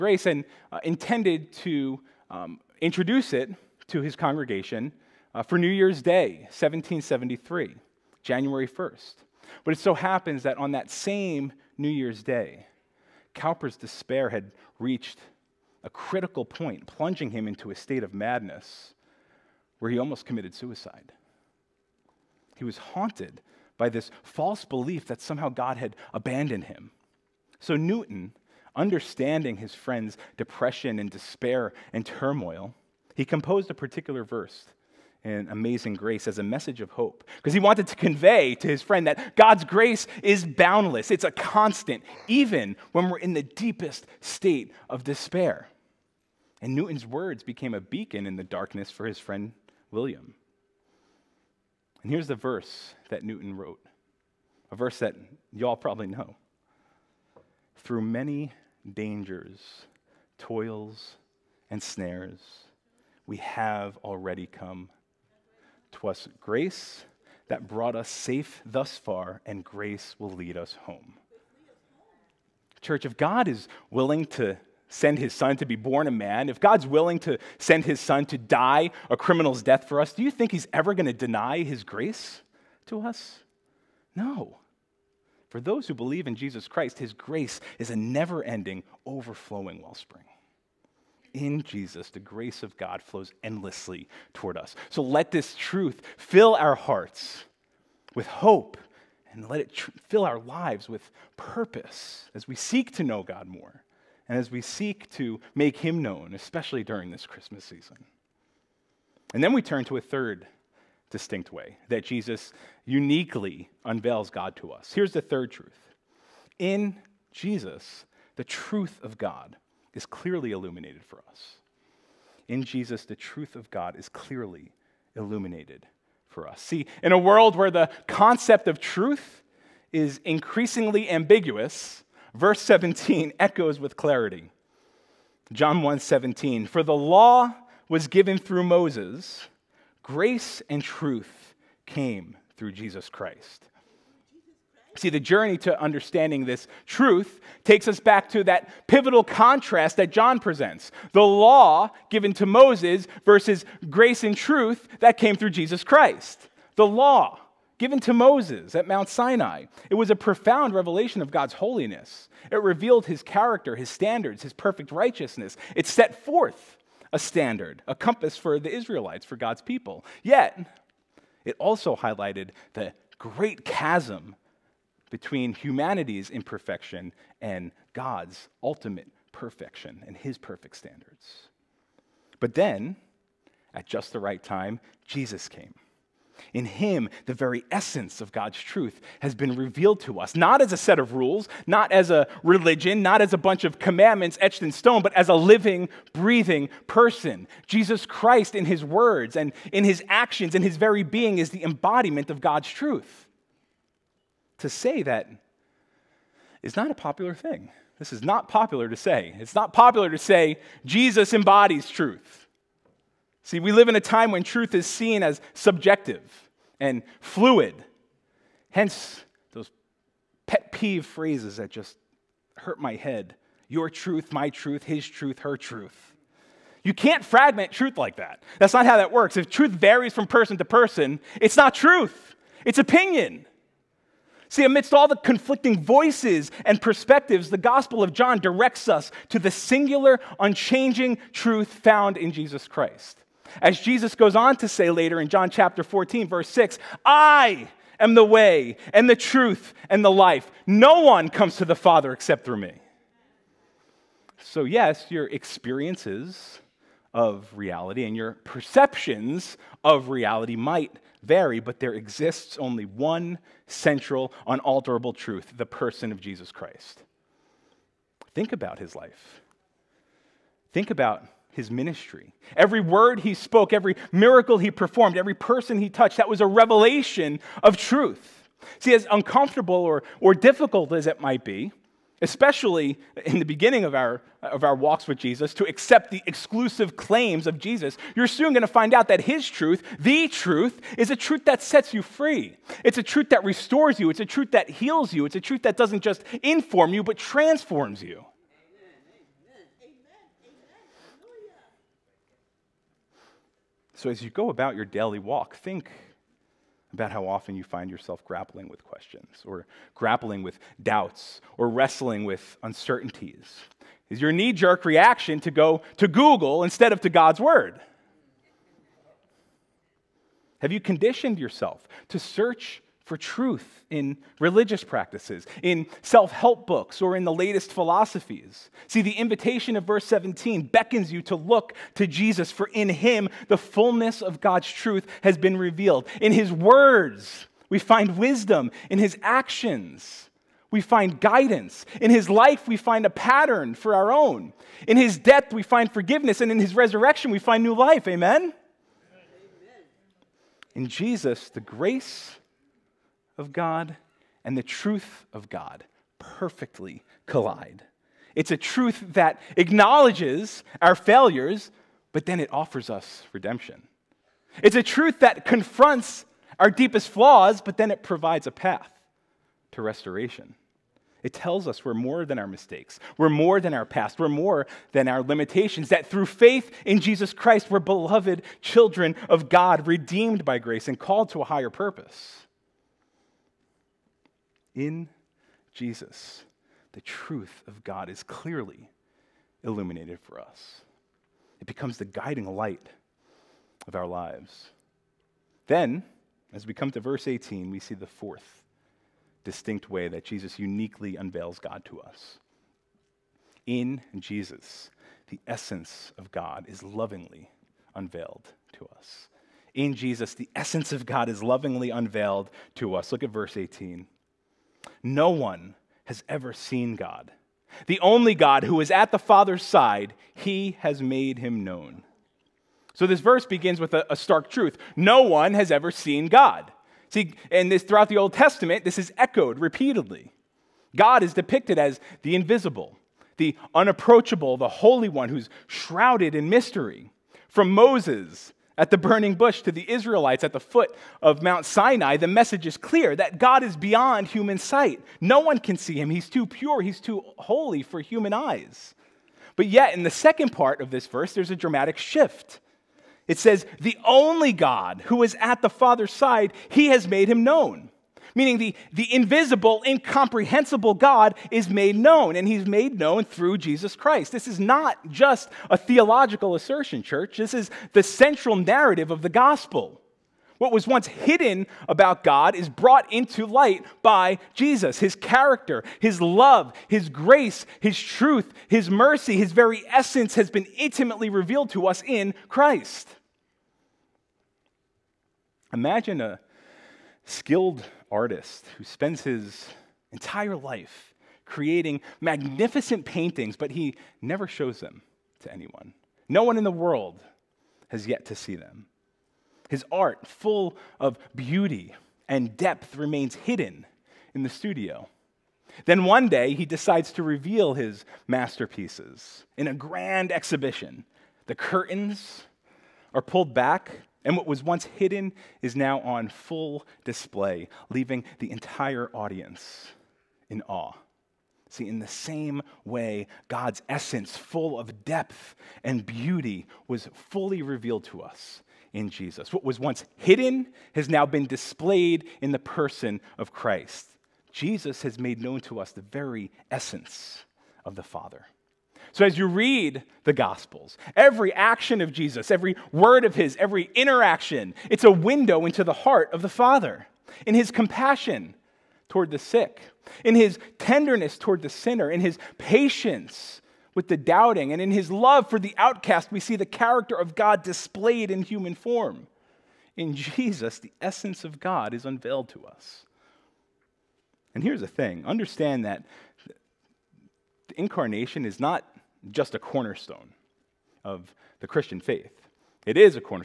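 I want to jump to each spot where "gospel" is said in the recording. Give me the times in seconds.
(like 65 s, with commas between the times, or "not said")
237 s, 469 s, 540 s.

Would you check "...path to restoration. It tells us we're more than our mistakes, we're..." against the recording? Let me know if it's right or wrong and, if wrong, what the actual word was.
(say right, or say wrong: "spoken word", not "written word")
right.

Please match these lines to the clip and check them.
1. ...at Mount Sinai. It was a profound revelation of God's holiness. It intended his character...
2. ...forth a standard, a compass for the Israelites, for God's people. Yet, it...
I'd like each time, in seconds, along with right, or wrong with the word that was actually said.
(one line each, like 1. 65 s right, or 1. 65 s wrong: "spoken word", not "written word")
1. 158 s wrong: "revealed", not "intended"
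2. 166 s right.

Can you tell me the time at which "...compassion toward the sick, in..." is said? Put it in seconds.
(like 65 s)
547 s.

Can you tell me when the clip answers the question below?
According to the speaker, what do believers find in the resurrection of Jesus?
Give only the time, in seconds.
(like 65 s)
347 s.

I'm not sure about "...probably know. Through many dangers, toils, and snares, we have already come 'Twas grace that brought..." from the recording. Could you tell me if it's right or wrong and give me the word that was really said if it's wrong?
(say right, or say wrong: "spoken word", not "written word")
right.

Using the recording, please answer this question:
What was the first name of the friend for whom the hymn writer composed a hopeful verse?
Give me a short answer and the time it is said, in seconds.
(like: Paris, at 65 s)
William, at 49 s.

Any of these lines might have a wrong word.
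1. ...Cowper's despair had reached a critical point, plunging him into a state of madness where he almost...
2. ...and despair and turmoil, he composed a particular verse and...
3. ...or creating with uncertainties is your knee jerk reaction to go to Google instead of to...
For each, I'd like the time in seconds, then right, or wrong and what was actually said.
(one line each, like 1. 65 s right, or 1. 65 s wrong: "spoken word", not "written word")
1. 13 s right
2. 30 s right
3. 311 s wrong: "wrestling", not "creating".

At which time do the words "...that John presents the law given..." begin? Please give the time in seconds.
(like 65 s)
149 s.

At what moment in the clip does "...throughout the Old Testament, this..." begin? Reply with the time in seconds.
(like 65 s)
427 s.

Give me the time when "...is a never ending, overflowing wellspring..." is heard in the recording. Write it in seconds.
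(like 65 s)
87 s.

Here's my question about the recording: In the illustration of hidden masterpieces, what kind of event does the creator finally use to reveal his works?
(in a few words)
grand exhibition.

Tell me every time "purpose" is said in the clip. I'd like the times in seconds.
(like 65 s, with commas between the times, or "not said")
101 s, 381 s.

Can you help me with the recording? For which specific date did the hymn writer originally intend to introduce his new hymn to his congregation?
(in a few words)
New Year's Day, 1773.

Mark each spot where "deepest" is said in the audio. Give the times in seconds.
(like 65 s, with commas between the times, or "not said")
43 s, 366 s.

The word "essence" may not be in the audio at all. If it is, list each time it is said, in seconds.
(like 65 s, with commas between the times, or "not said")
187 s, 405 s, 410 s, 479 s, 523 s, 536 s, 561 s.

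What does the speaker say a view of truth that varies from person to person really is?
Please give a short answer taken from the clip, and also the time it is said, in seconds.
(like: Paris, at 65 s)
opinion, at 232 s.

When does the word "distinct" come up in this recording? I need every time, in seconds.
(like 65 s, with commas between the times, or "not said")
111 s, 399 s.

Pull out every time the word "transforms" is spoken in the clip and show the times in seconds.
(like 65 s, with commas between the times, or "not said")
297 s.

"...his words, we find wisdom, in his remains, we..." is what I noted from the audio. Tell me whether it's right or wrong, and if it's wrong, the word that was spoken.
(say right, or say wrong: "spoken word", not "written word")
wrong: "actions", not "remains".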